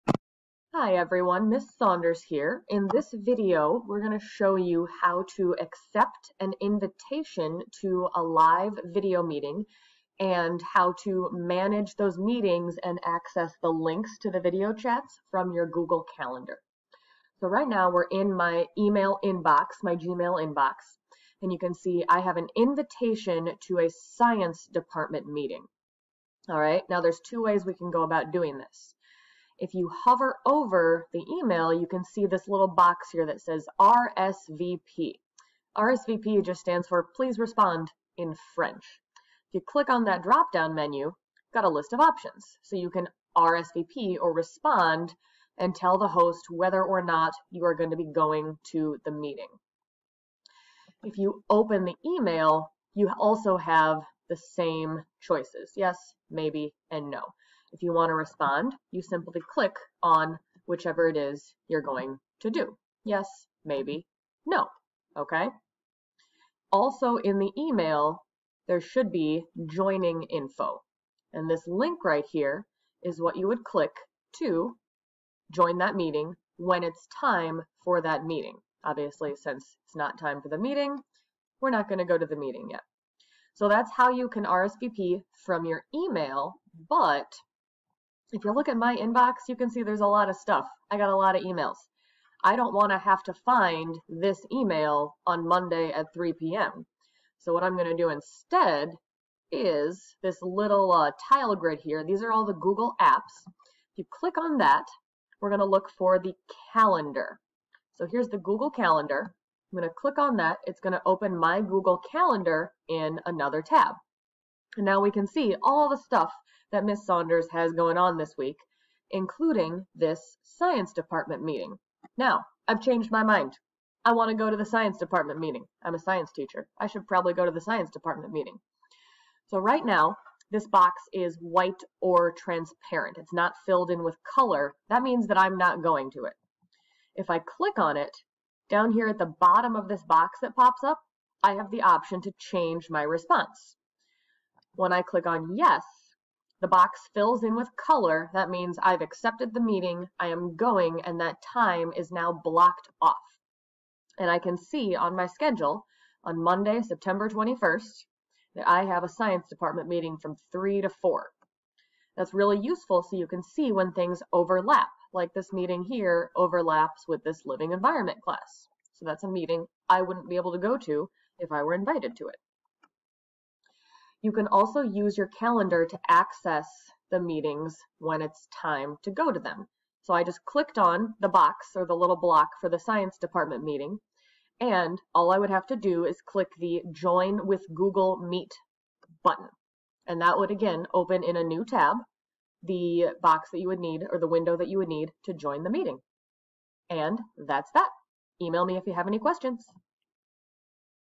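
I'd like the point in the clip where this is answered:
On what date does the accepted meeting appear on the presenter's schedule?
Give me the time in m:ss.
2:36.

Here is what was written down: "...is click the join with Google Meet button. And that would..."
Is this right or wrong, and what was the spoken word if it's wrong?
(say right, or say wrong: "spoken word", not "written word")
right.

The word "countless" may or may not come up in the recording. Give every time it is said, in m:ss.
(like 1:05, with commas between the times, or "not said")
not said.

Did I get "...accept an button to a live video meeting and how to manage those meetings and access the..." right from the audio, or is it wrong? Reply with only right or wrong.
wrong.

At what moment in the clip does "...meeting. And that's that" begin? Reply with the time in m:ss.
3:15.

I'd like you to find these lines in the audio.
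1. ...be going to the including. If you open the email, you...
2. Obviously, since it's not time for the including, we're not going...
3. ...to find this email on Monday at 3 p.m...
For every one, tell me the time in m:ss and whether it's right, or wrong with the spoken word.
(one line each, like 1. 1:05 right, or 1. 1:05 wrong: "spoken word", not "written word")
1. 0:47 wrong: "meeting", not "including"
2. 1:18 wrong: "meeting", not "including"
3. 1:33 right.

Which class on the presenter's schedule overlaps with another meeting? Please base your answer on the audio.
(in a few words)
Living environment.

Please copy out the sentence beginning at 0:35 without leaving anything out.
RSVP just stands for please respond in French.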